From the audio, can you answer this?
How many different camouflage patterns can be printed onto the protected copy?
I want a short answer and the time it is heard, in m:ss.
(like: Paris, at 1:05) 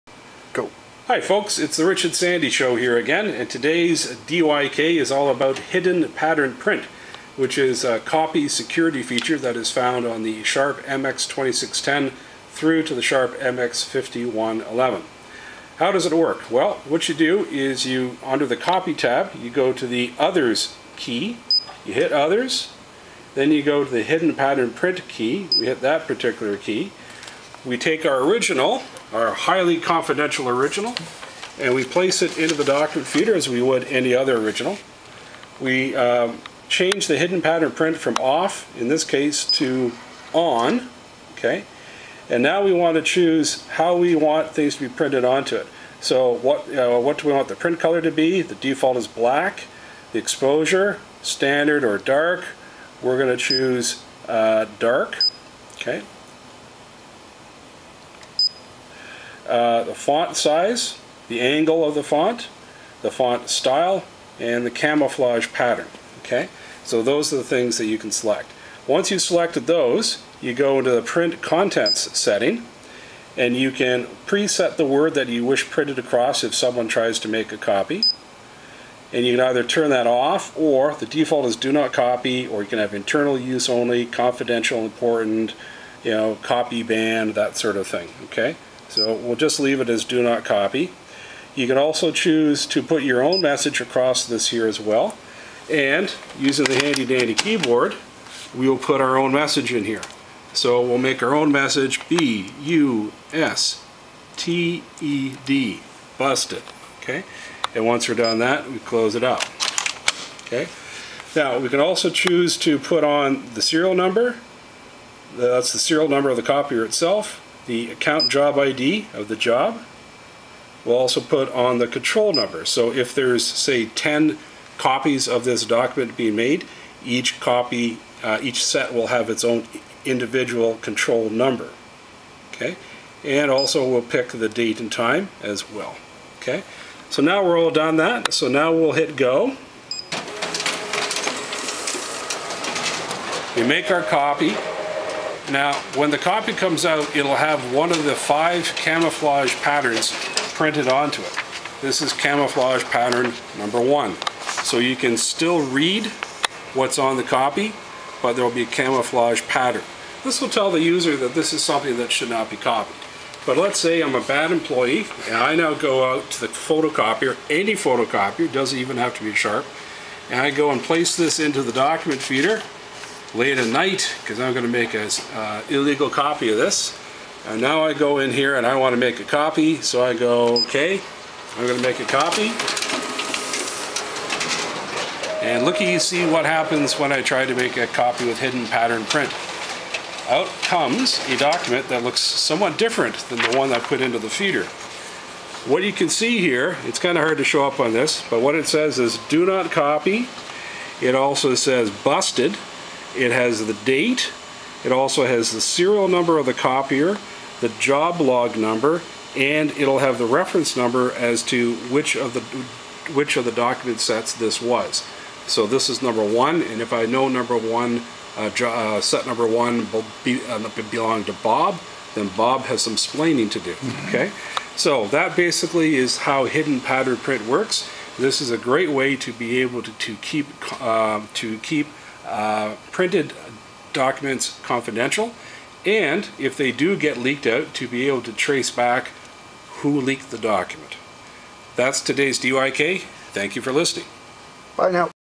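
5, at 2:28.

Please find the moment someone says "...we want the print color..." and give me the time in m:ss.
0:47.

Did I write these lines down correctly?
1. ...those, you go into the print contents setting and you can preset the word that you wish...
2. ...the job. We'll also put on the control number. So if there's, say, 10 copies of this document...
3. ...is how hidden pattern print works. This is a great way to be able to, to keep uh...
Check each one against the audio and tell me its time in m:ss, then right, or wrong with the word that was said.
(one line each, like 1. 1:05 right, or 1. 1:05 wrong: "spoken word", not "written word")
1. 1:09 right
2. 1:59 right
3. 3:45 right.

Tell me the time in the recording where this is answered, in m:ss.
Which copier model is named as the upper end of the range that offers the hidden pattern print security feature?
0:13.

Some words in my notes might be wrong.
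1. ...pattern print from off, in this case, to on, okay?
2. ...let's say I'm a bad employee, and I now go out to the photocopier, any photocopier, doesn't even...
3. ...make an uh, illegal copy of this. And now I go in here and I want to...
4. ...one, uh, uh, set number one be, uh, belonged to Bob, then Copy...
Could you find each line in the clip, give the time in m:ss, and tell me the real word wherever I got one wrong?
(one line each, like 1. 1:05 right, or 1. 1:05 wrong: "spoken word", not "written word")
1. 0:37 right
2. 2:43 right
3. 2:54 right
4. 3:37 wrong: "Bob", not "Copy".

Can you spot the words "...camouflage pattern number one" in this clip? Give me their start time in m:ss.
2:32.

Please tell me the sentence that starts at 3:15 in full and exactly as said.
What you can see here, it's kind of hard to show up on this, but what it says is do not copy.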